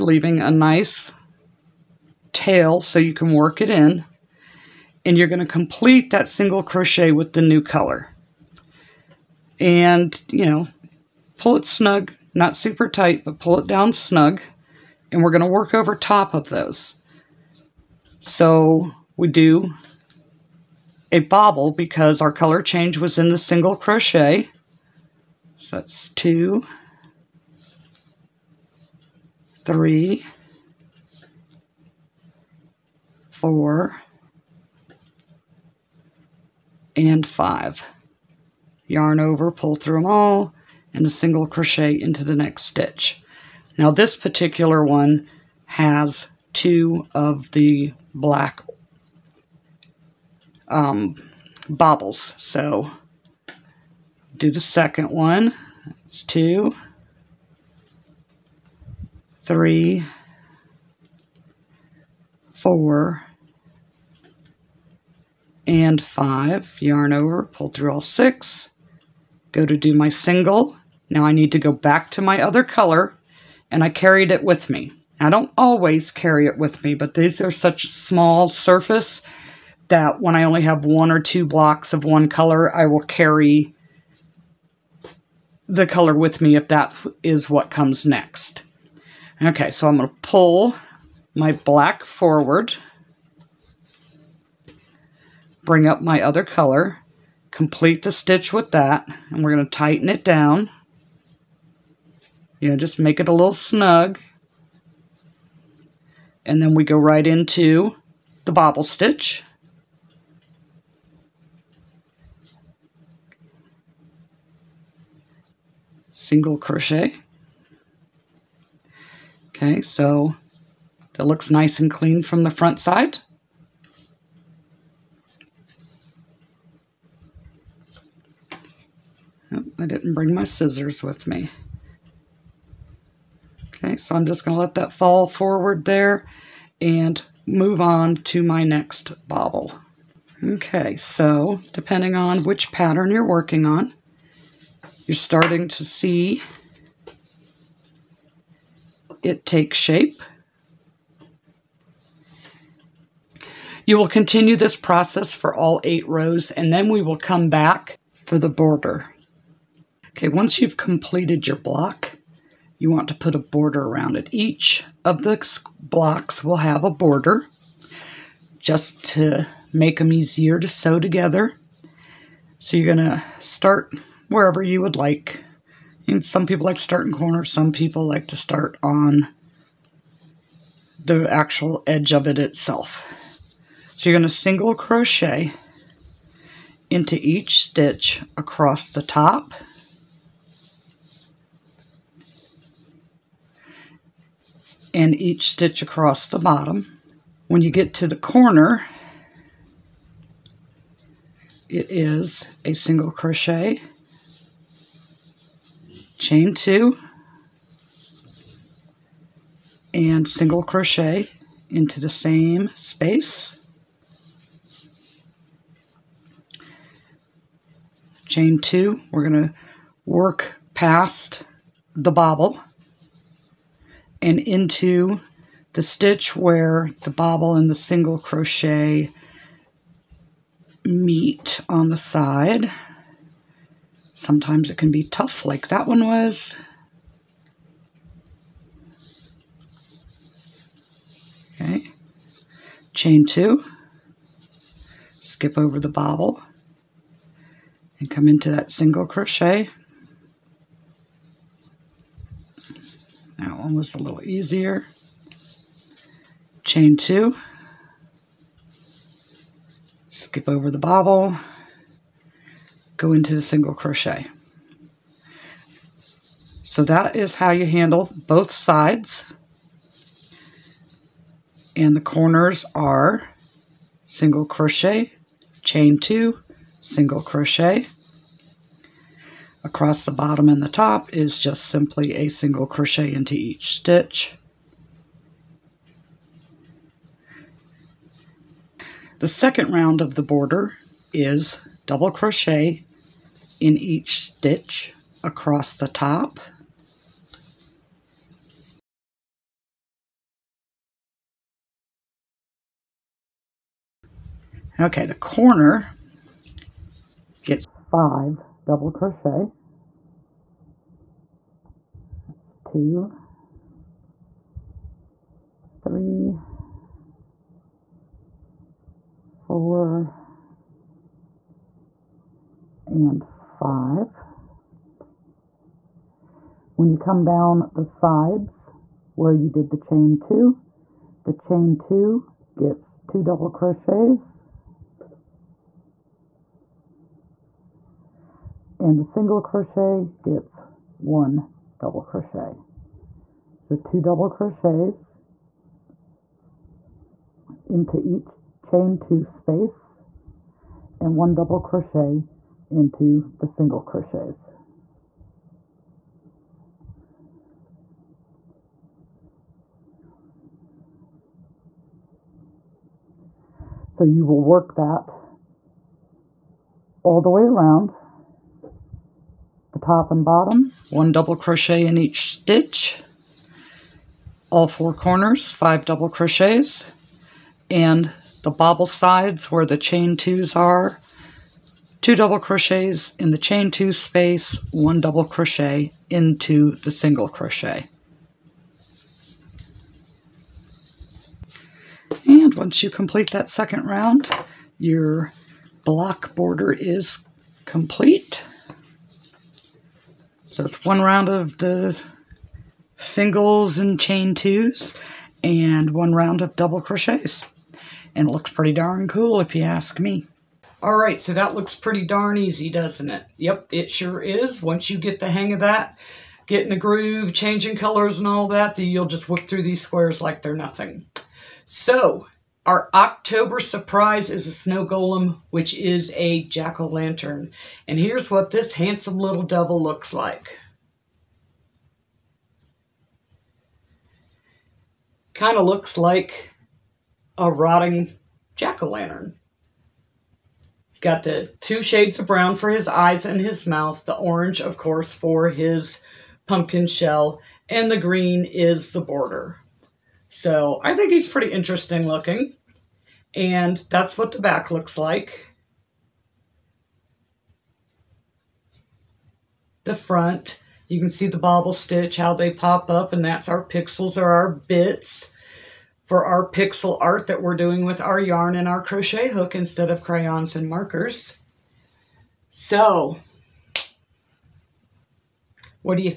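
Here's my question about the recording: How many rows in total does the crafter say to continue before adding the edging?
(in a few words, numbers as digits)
8.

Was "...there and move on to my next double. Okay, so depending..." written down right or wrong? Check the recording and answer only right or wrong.
wrong.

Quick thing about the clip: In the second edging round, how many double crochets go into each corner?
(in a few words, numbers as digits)
5.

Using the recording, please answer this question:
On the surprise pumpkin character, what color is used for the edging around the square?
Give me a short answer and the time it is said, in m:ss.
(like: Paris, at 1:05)
green, at 7:27.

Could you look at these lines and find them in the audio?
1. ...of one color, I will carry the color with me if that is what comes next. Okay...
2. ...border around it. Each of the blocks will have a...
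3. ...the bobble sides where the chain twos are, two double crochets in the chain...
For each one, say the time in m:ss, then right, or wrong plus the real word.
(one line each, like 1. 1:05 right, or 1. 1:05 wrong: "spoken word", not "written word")
1. 1:21 right
2. 2:43 right
3. 6:18 right.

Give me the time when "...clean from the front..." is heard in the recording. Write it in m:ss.
2:01.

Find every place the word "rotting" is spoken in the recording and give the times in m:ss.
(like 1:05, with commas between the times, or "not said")
7:17.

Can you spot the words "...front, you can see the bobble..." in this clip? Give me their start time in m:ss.
7:39.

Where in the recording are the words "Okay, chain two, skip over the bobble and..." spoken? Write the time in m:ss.
4:01.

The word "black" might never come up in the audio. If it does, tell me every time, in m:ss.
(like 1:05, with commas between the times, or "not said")
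0:48, 1:31.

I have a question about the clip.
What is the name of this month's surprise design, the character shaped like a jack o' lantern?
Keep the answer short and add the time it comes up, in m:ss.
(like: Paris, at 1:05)
snow golem, at 7:04.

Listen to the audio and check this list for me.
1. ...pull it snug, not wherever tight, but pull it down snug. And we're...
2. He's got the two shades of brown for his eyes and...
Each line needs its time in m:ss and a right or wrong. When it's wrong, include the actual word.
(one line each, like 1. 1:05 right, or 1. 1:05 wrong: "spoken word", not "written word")
1. 0:11 wrong: "super", not "wherever"
2. 7:20 right.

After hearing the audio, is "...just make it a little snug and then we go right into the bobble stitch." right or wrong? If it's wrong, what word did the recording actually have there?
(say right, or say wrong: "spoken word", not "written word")
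right.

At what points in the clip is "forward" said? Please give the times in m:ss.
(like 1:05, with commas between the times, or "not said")
1:32, 2:15.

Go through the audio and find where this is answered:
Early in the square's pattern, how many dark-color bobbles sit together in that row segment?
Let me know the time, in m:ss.
0:46.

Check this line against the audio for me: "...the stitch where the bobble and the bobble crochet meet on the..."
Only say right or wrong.
wrong.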